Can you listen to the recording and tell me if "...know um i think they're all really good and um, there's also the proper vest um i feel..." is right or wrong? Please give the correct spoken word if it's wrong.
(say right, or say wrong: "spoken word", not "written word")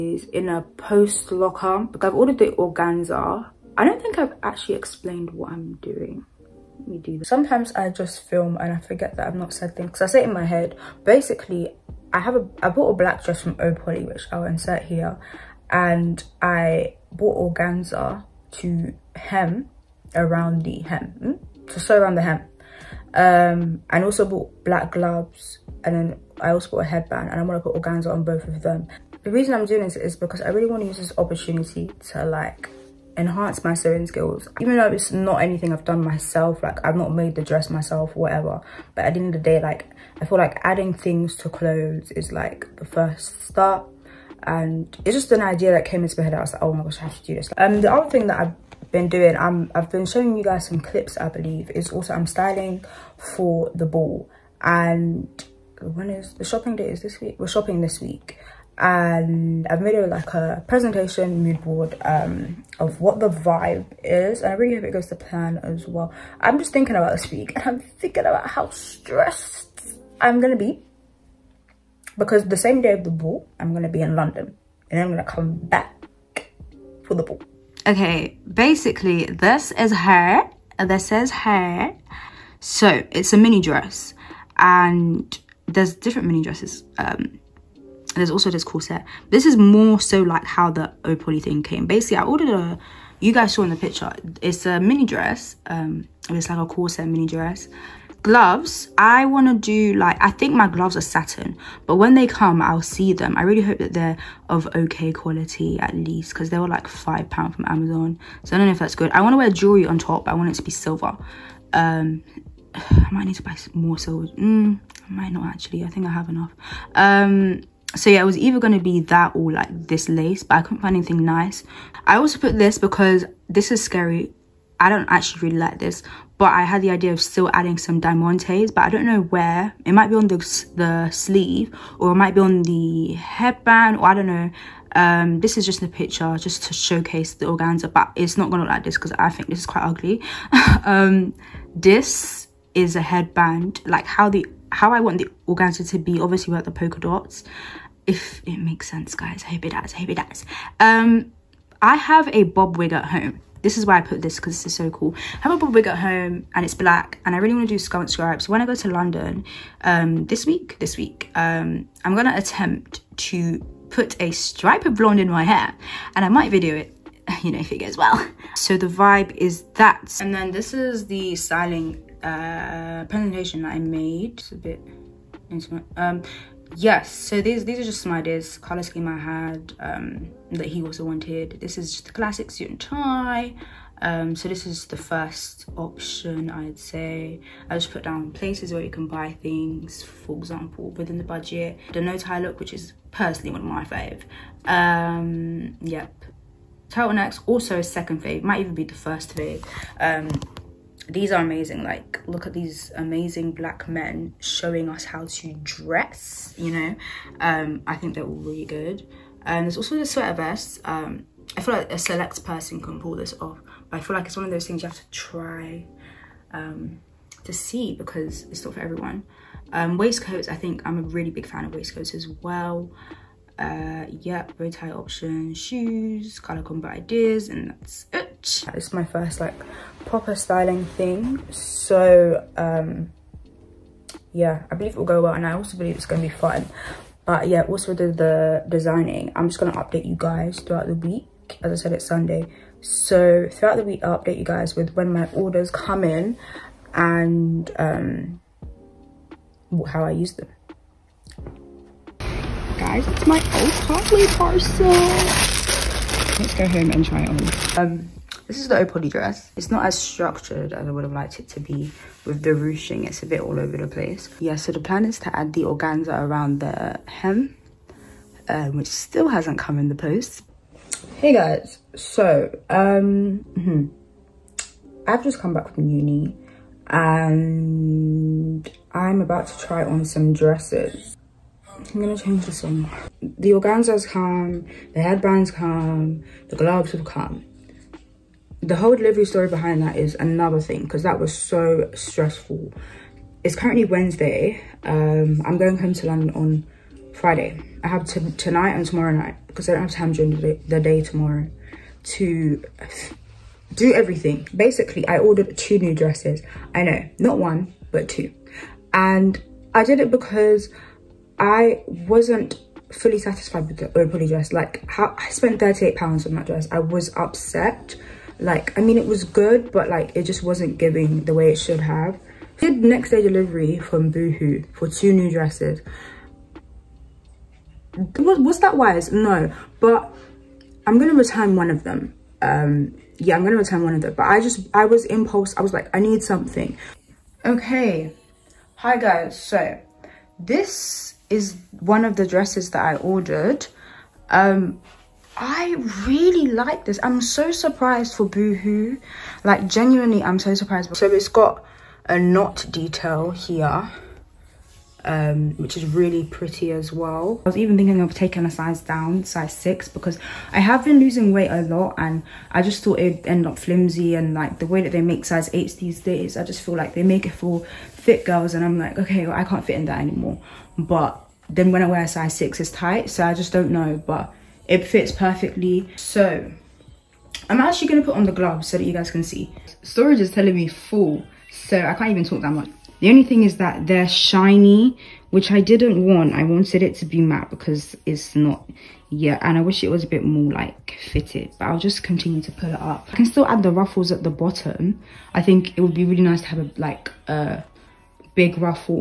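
wrong: "sweater", not "proper".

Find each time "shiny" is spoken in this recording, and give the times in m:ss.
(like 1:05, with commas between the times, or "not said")
6:24.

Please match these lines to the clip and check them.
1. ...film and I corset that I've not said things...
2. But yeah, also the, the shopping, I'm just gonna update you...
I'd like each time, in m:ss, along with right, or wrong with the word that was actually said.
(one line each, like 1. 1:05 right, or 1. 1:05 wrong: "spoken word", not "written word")
1. 0:08 wrong: "forget", not "corset"
2. 3:57 wrong: "designing", not "shopping".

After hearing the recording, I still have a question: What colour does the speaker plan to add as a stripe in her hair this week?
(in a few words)
Blonde.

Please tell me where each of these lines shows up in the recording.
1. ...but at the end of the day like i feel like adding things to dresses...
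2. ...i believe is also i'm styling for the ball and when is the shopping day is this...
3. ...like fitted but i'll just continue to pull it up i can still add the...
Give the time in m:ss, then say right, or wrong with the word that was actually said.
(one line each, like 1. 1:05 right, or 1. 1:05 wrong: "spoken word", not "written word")
1. 0:38 wrong: "clothes", not "dresses"
2. 0:51 right
3. 6:30 right.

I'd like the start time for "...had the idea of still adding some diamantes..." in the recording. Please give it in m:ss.
2:06.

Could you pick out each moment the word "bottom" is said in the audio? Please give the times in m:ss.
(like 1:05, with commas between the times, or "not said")
6:34.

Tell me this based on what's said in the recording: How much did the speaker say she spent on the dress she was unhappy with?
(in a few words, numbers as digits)
£38.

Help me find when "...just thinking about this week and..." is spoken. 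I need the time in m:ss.
1:06.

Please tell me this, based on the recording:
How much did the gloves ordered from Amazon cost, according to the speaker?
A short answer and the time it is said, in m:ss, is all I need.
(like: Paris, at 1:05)
£5, at 1:46.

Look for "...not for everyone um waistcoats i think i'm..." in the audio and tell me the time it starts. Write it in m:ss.
3:38.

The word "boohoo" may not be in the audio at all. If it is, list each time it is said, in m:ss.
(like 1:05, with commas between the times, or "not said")
5:24, 5:48.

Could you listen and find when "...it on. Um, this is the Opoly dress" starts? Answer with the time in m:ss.
4:17.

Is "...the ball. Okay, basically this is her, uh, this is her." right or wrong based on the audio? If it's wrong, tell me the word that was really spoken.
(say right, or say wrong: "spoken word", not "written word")
right.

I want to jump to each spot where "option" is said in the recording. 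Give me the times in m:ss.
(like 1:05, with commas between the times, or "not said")
3:05, 3:44.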